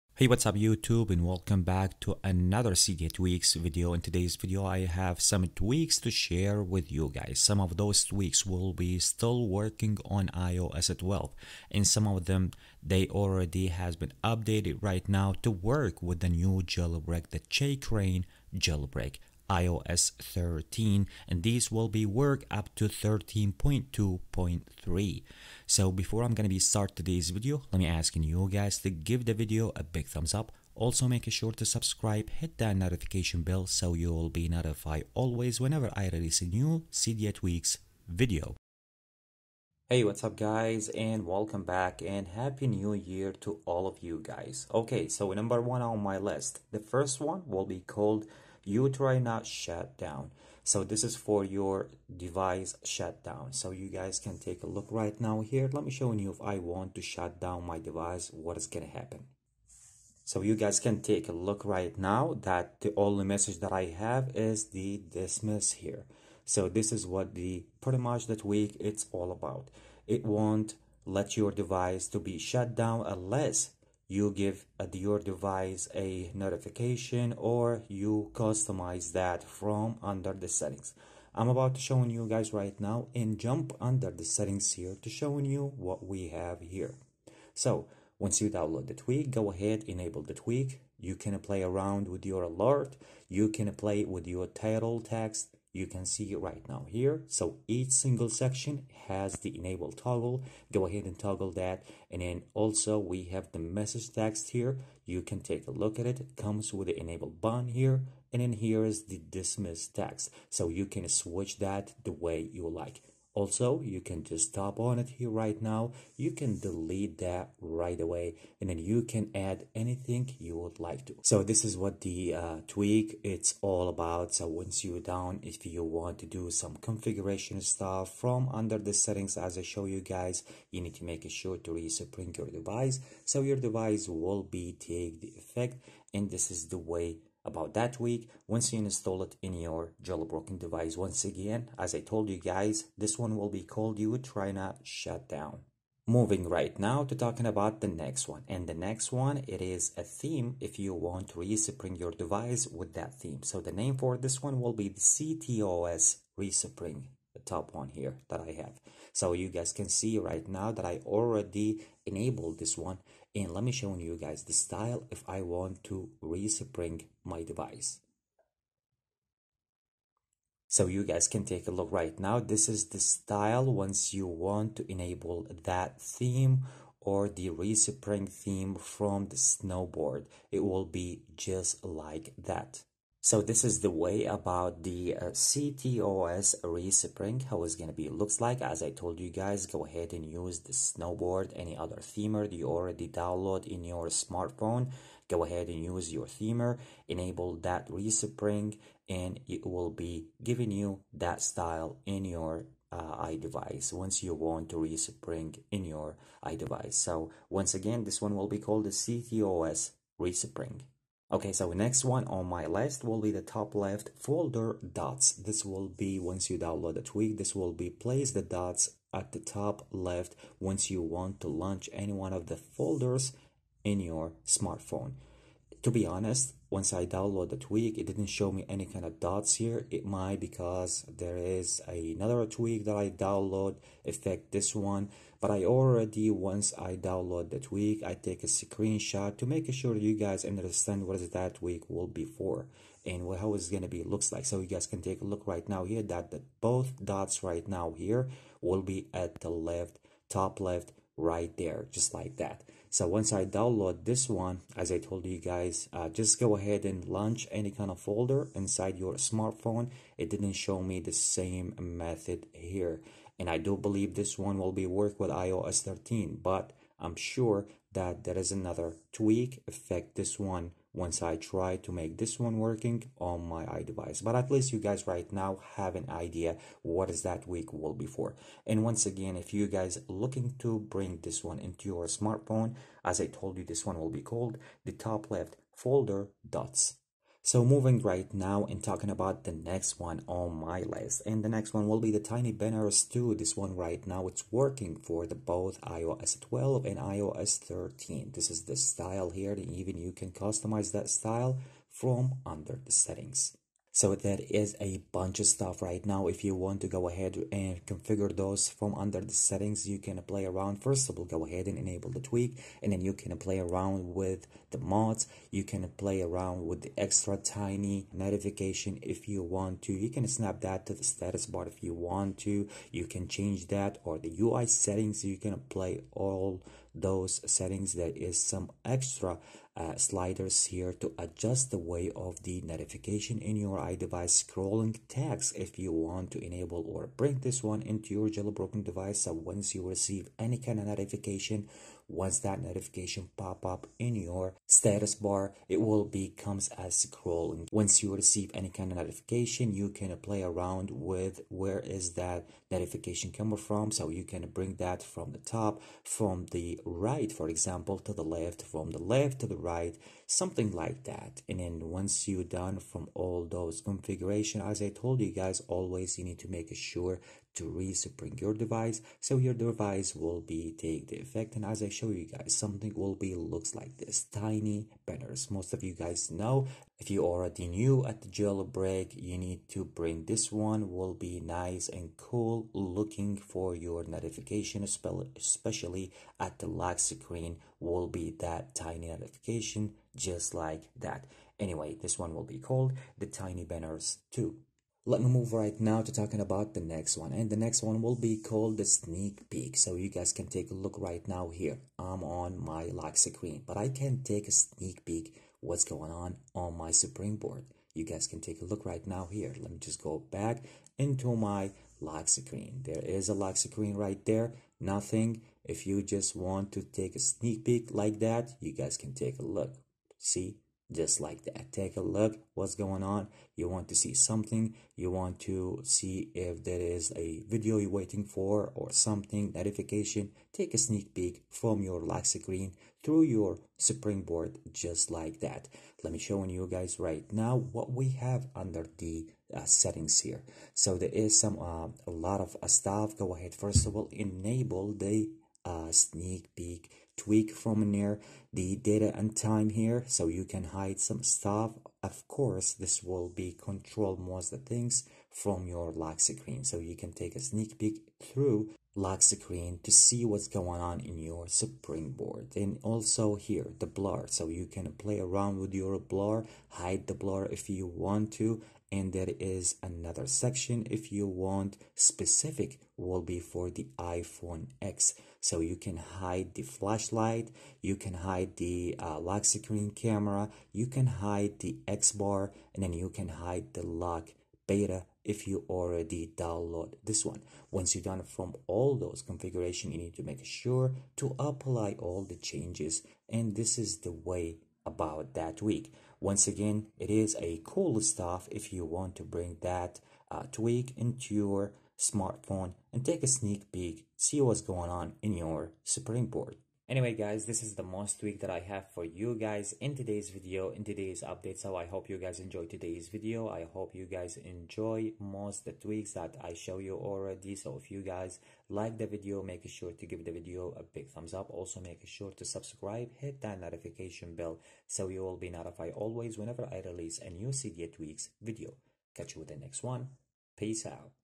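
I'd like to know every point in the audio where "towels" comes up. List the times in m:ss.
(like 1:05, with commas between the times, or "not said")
not said.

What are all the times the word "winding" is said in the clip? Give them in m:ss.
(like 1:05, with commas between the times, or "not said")
not said.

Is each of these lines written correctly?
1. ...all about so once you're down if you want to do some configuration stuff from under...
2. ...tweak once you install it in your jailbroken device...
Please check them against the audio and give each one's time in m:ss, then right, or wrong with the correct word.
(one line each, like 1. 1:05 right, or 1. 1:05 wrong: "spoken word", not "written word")
1. 2:03 right
2. 2:17 right.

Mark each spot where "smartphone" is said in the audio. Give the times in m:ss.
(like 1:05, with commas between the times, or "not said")
3:14, 3:44, 4:19, 4:42, 8:21.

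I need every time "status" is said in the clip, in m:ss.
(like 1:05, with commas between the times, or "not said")
5:21, 5:44.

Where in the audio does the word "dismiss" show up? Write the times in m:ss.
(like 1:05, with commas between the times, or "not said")
1:05, 1:49.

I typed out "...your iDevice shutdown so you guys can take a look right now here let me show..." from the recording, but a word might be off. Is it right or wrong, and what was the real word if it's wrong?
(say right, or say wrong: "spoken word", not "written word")
wrong: "device", not "iDevice".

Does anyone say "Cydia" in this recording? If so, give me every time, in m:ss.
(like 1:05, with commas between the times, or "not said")
0:02, 0:36, 8:47.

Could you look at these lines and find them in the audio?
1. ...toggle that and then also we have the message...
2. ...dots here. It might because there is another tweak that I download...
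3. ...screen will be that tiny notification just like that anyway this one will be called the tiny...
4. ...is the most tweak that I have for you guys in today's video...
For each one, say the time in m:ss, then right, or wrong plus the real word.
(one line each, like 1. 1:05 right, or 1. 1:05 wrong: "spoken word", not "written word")
1. 1:41 right
2. 3:49 right
3. 6:26 right
4. 8:27 right.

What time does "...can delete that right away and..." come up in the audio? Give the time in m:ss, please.
1:56.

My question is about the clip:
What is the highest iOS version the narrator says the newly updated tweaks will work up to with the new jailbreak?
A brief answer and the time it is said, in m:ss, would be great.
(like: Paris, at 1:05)
13.2.3, at 0:22.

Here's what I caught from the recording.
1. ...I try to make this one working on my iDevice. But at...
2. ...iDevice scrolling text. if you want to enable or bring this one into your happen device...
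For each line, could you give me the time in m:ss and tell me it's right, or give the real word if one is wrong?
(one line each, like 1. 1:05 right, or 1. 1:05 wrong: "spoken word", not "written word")
1. 4:31 right
2. 5:33 wrong: "jailbroken", not "happen".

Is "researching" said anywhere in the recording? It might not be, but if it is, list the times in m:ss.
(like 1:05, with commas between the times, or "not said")
not said.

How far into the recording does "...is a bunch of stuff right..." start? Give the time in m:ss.
5:04.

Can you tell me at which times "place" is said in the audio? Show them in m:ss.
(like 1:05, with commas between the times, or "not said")
3:37.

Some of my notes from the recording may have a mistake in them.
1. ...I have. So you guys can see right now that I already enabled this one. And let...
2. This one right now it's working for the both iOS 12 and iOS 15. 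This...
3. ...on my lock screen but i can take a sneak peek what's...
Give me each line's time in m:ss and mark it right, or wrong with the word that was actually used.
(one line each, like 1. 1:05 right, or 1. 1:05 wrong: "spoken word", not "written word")
1. 2:38 right
2. 4:53 wrong: "13", not "15"
3. 6:42 right.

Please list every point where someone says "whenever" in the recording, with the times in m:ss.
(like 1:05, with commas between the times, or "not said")
0:35, 8:46.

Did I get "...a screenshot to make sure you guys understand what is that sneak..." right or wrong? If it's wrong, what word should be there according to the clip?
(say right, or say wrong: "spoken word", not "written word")
wrong: "tweak", not "sneak".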